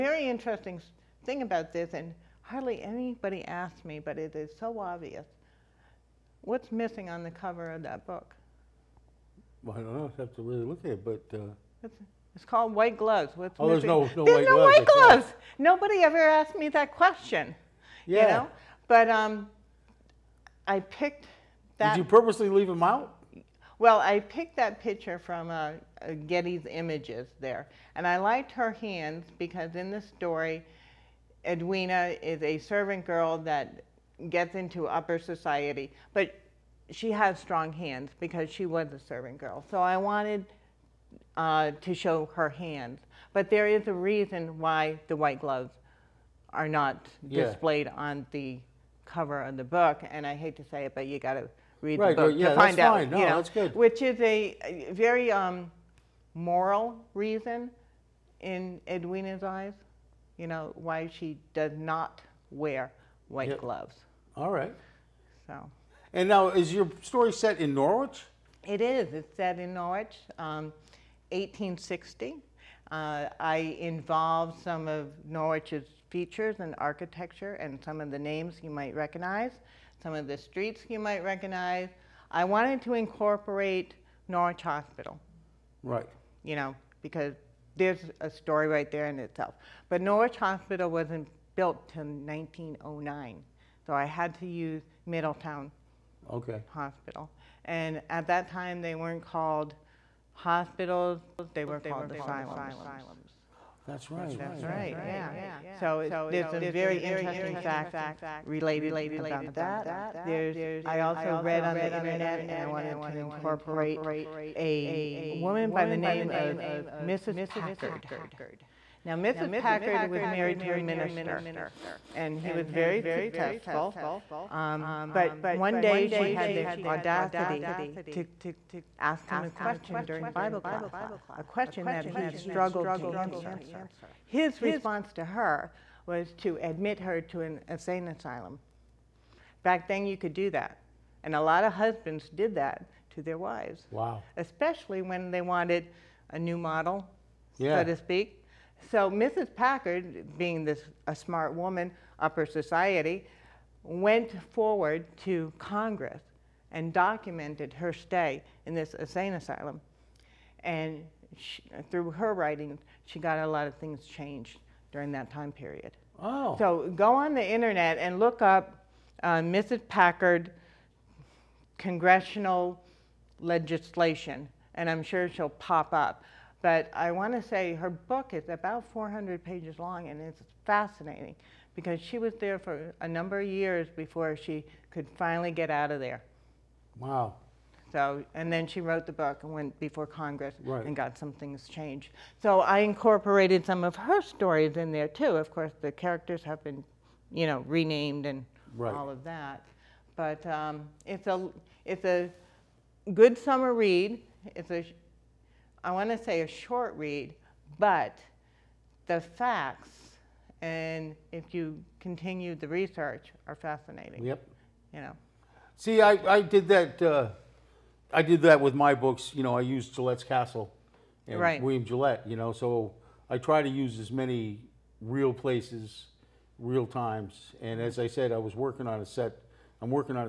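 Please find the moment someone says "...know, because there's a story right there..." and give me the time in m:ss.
1:26.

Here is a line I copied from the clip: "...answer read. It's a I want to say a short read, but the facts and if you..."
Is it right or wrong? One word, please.
wrong.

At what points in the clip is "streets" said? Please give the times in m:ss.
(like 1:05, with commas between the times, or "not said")
1:20.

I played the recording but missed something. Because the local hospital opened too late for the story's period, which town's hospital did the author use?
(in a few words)
Middletown.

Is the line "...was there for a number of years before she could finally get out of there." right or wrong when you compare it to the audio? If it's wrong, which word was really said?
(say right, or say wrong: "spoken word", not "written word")
right.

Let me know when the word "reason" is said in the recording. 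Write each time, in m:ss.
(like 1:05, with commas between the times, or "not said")
0:43, 0:57.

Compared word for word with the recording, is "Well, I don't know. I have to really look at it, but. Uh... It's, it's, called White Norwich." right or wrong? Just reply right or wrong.
wrong.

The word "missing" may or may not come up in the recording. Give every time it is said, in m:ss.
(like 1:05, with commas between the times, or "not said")
0:06, 0:13.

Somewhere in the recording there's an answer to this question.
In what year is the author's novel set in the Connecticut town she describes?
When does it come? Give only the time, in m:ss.
1:11.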